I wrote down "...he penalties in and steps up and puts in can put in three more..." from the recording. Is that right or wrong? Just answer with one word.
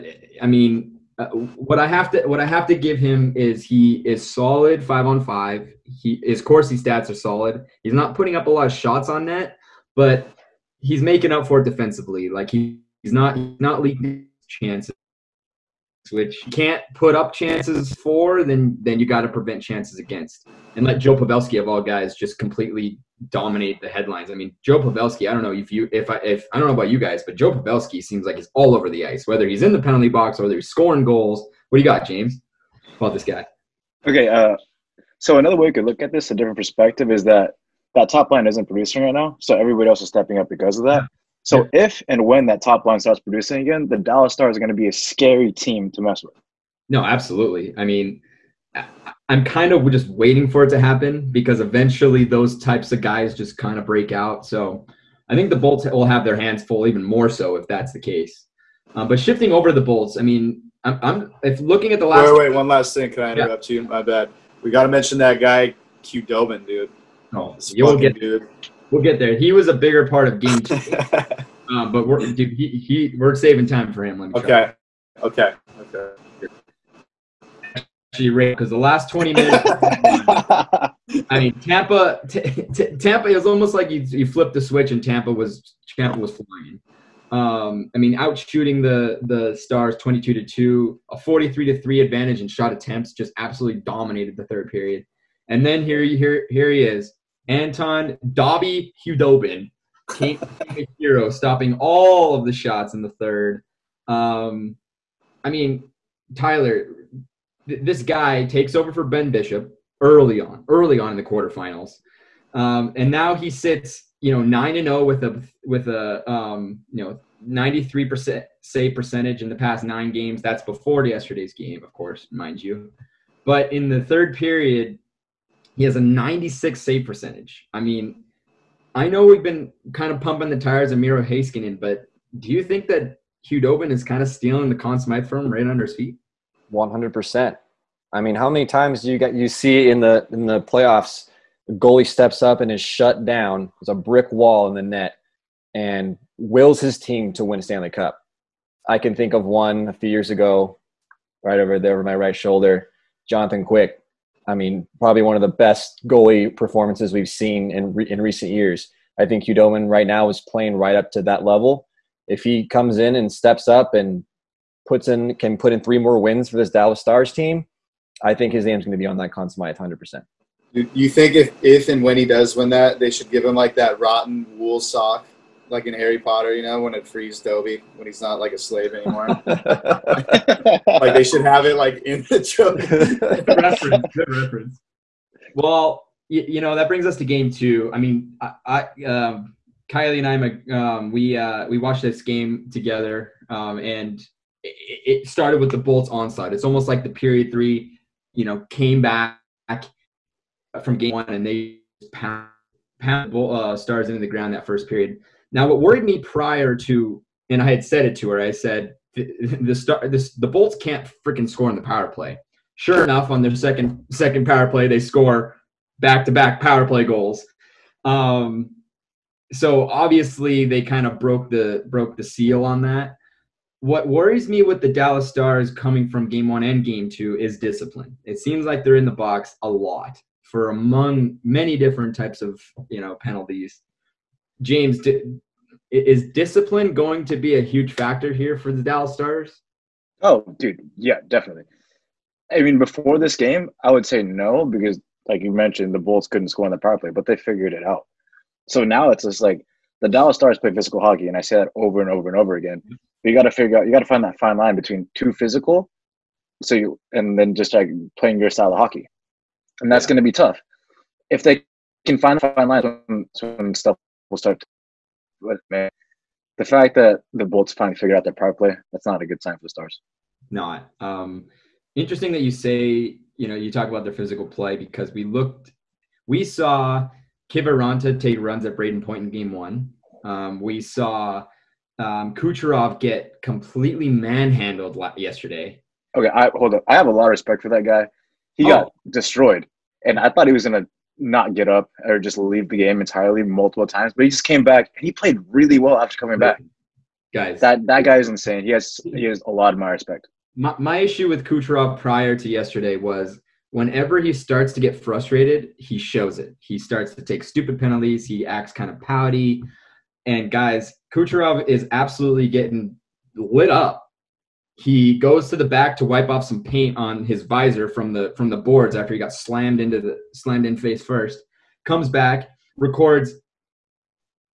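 wrong.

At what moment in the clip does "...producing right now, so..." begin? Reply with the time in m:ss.
0:38.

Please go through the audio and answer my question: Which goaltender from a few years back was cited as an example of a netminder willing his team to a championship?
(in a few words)
Jonathan Quick.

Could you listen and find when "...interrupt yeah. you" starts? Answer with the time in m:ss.
1:03.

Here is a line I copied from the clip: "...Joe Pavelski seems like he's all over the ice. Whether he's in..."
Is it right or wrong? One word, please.
right.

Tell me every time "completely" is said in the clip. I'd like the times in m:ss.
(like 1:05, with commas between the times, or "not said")
0:22, 4:43.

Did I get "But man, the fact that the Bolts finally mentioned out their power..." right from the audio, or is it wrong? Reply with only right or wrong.
wrong.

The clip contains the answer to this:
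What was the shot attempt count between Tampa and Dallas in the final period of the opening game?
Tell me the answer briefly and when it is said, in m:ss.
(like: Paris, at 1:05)
43 to 3, at 1:31.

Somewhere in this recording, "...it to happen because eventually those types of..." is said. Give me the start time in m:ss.
0:50.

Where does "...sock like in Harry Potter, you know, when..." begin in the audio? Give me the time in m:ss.
2:54.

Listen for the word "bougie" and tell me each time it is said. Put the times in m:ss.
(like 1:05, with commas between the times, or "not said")
not said.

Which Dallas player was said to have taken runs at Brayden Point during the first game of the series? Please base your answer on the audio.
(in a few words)
Kiviranta.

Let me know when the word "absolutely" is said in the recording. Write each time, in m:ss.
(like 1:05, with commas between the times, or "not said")
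0:47, 1:33, 5:11.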